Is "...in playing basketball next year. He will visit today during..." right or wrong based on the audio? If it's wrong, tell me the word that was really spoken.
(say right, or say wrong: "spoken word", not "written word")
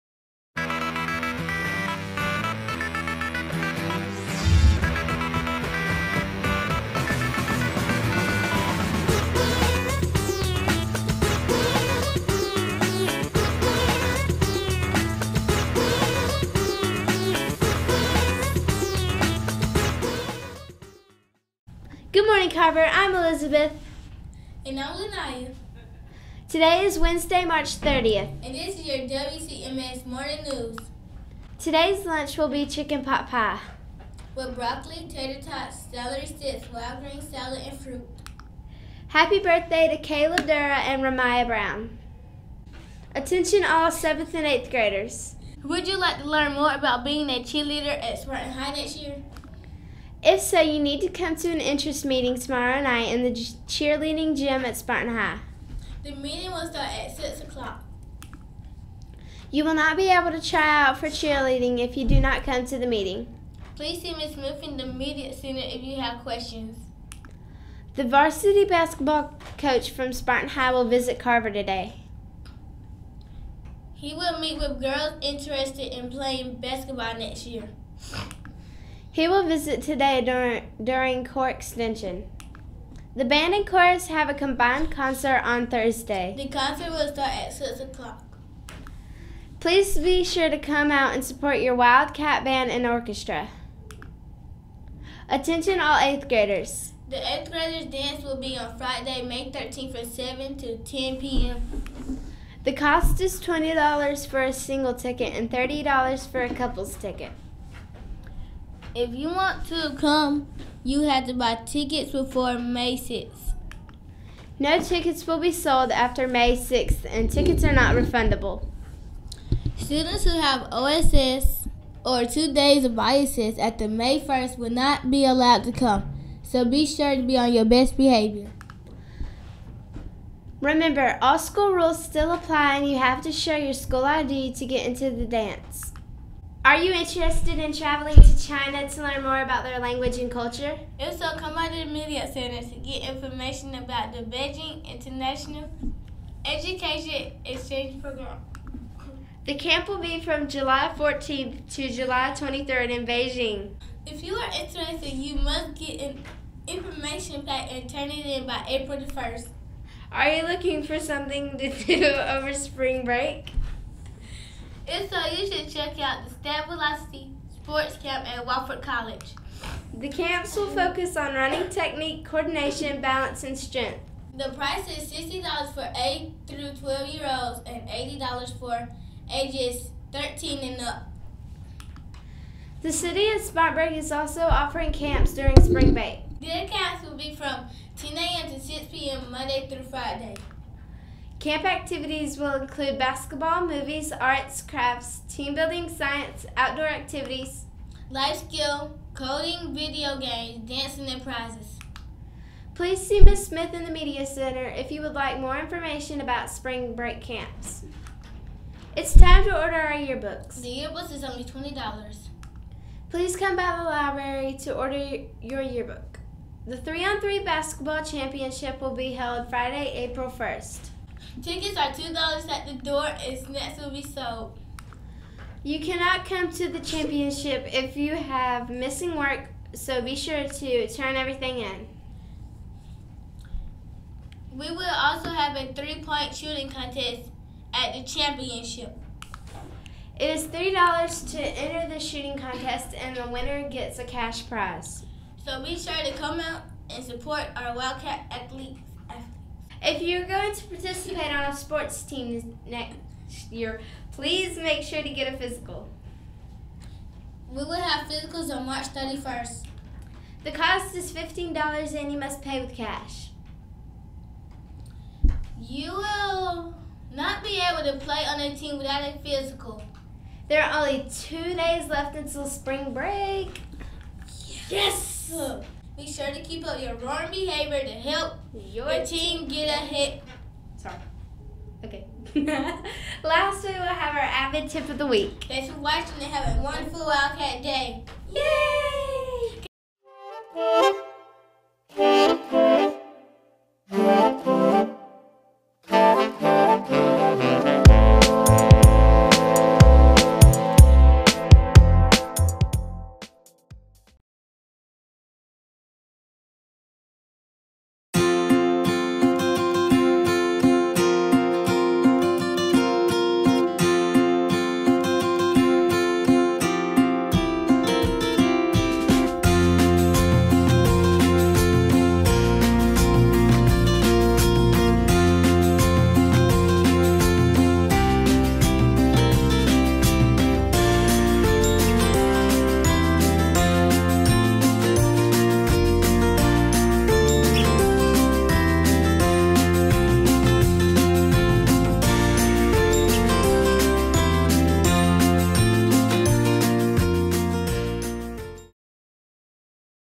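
right.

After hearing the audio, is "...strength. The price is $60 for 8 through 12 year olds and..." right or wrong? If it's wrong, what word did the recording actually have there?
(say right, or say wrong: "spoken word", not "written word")
right.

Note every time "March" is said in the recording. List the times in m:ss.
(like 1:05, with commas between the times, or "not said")
0:27, 4:18.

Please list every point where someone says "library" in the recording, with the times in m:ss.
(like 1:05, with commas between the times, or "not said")
3:33.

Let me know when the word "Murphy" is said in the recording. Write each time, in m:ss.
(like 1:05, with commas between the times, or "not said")
1:04.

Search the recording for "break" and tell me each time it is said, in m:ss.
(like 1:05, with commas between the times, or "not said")
2:43, 3:05, 3:26, 4:32.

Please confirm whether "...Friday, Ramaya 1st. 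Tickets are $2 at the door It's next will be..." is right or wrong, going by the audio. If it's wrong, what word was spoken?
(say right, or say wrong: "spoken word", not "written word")
wrong: "April", not "Ramaya".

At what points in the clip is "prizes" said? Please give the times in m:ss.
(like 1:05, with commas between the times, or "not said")
3:21, 4:04.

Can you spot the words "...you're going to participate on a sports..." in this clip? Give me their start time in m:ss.
4:10.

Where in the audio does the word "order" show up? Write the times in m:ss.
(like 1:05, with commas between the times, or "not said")
3:29, 3:34.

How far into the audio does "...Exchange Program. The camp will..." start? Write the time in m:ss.
2:27.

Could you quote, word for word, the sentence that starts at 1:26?
The concert will start at 6 o'clock.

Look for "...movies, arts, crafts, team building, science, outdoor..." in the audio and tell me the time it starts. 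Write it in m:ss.
3:13.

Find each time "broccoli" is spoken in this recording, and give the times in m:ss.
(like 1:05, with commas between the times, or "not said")
0:34.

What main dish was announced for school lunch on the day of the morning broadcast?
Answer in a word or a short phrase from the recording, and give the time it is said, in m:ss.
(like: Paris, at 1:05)
Chicken pot pie, at 0:32.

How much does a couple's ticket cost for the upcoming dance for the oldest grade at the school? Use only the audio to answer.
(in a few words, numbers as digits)
$30.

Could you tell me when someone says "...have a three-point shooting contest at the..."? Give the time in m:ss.
3:55.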